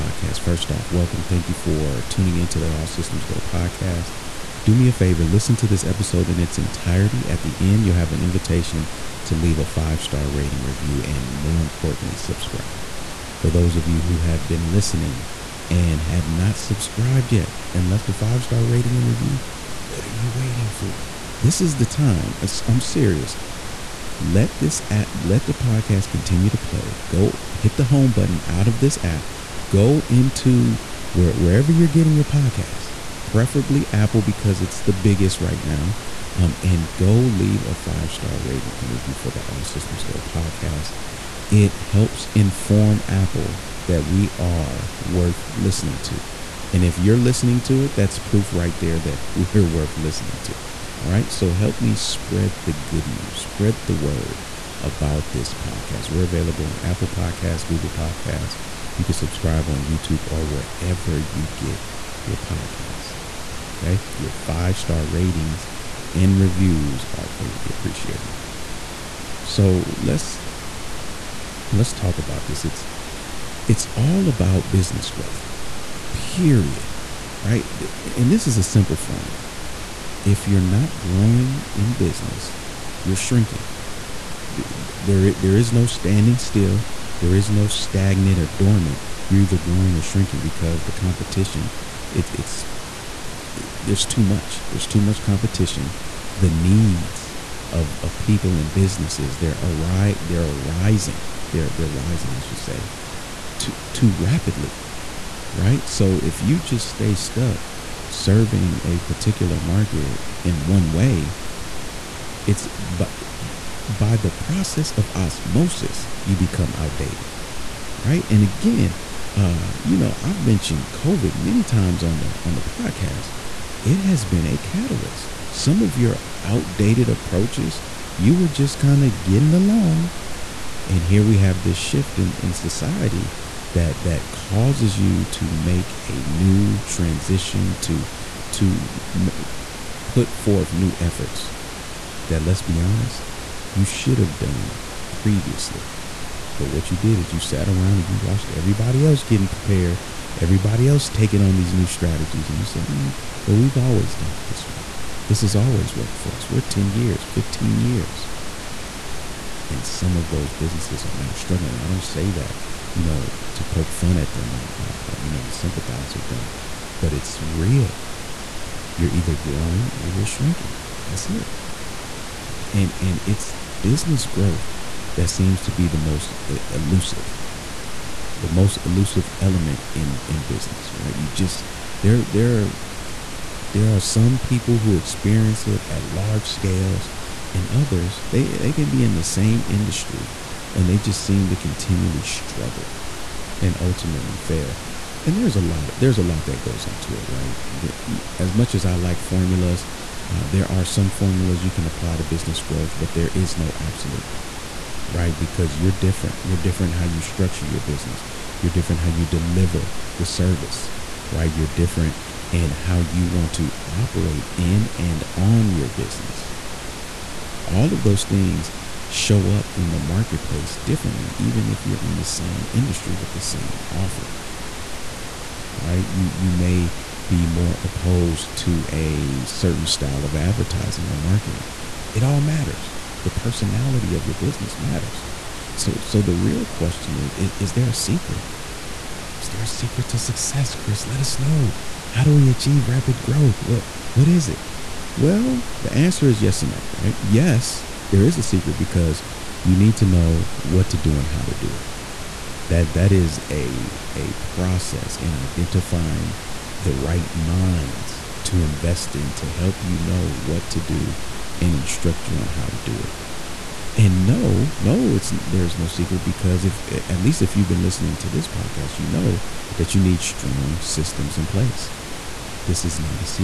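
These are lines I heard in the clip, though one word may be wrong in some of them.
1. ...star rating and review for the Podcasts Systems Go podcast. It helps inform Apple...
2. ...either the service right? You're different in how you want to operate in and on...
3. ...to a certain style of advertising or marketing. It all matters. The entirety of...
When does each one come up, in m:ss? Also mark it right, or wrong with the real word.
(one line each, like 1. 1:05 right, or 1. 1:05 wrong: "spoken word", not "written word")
1. 0:38 wrong: "All", not "Podcasts"
2. 3:29 wrong: "deliver", not "either"
3. 3:48 wrong: "personality", not "entirety".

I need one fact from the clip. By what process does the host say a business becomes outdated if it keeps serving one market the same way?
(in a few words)
osmosis.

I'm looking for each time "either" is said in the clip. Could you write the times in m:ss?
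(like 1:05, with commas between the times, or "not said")
1:29, 2:49.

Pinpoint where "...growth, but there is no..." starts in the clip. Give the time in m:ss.
3:22.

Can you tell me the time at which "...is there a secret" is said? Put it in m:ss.
3:57.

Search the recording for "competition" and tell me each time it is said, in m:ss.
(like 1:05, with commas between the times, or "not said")
1:30, 1:35.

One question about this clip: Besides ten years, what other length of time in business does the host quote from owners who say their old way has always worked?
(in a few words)
15 years.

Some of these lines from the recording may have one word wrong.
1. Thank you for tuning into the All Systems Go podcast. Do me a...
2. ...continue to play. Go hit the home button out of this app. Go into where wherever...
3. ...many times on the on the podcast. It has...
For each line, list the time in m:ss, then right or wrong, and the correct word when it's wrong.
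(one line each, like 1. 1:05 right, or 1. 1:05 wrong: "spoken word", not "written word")
1. 0:01 right
2. 0:26 right
3. 2:01 right.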